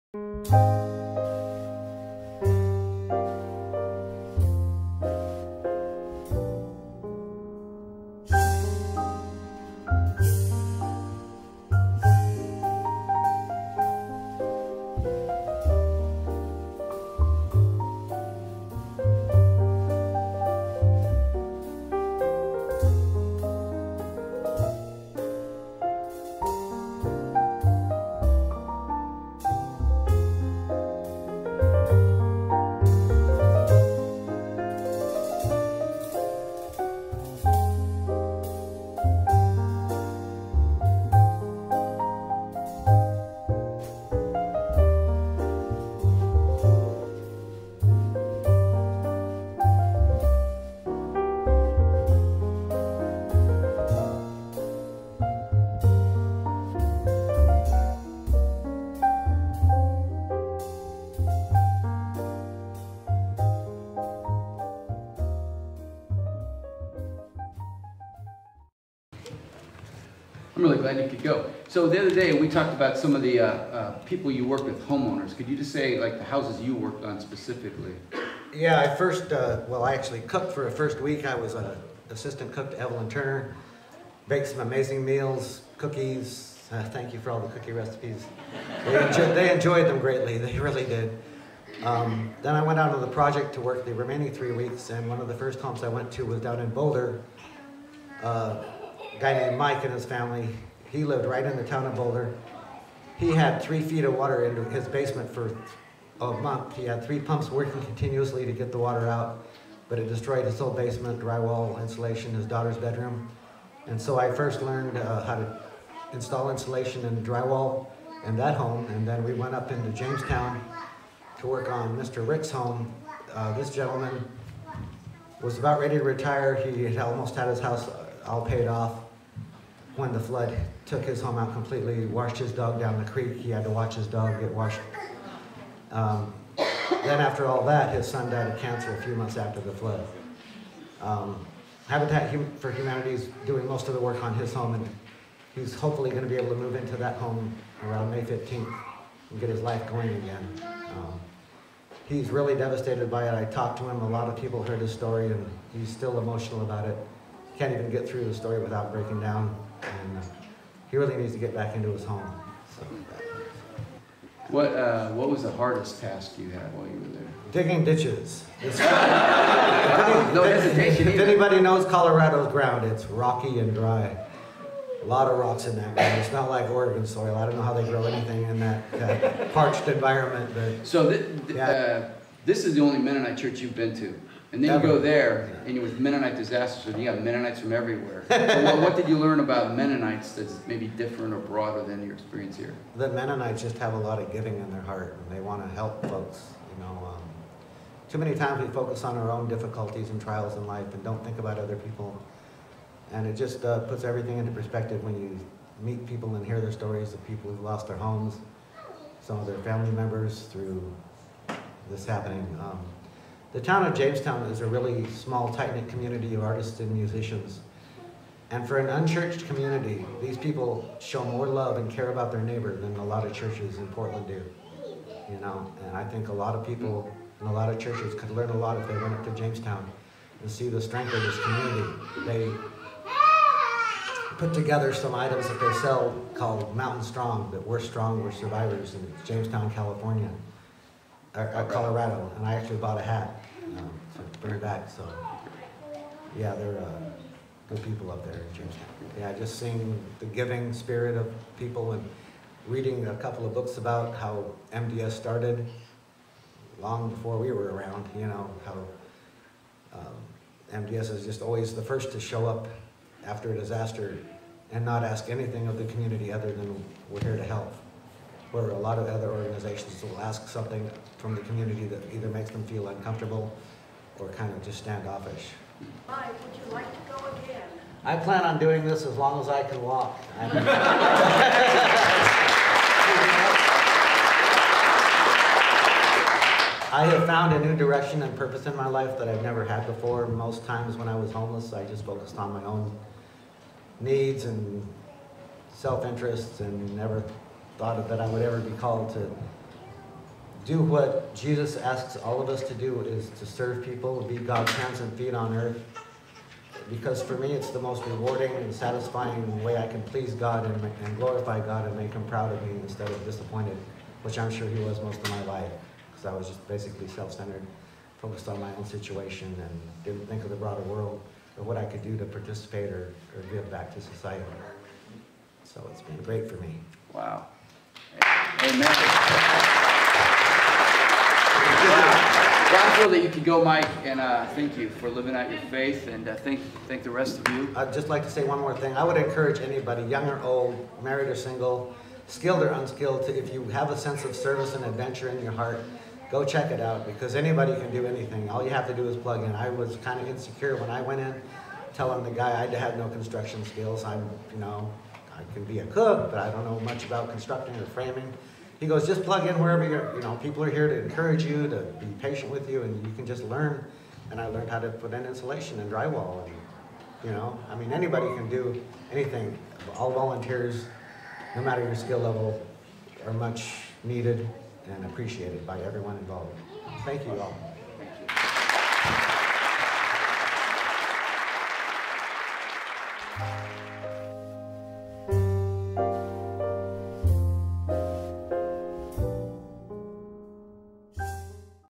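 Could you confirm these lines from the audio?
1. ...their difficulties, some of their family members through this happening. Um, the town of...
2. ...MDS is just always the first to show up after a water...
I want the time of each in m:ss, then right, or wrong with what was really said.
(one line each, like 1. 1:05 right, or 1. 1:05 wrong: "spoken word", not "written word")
1. 3:27 wrong: "homes", not "difficulties"
2. 4:20 wrong: "disaster", not "water".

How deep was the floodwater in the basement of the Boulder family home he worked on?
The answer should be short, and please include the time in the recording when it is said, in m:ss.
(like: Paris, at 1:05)
3 feet, at 1:43.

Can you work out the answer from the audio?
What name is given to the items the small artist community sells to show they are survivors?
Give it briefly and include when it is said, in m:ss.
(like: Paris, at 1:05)
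Mountain Strong, at 3:56.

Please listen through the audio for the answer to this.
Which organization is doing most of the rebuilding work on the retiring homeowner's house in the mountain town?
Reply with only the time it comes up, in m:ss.
2:21.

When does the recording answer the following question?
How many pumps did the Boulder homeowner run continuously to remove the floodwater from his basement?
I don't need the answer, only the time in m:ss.
1:47.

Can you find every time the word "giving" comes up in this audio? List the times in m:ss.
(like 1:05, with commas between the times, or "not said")
3:14, 4:10.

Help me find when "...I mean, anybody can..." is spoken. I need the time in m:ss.
6:07.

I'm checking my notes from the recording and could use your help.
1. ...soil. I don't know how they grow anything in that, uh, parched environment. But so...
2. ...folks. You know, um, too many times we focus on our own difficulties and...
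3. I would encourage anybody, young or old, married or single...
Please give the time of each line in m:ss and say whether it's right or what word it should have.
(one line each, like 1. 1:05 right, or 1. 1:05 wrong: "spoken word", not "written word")
1. 2:57 right
2. 3:16 right
3. 5:38 right.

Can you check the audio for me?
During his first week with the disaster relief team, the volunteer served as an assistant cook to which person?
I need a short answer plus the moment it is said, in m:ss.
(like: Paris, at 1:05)
Evelyn Turner, at 1:22.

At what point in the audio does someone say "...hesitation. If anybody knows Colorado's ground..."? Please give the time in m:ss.
2:50.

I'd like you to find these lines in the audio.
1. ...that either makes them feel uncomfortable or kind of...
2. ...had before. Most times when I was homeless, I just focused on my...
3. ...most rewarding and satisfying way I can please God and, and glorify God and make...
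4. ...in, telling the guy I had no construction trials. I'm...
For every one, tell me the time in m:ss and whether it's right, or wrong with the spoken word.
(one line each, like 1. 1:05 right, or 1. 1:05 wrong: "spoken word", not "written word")
1. 4:31 right
2. 4:49 right
3. 5:07 right
4. 5:51 wrong: "skills", not "trials".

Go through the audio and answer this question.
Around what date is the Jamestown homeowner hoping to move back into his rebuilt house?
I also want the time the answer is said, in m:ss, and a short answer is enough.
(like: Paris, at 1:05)
May 15, at 2:28.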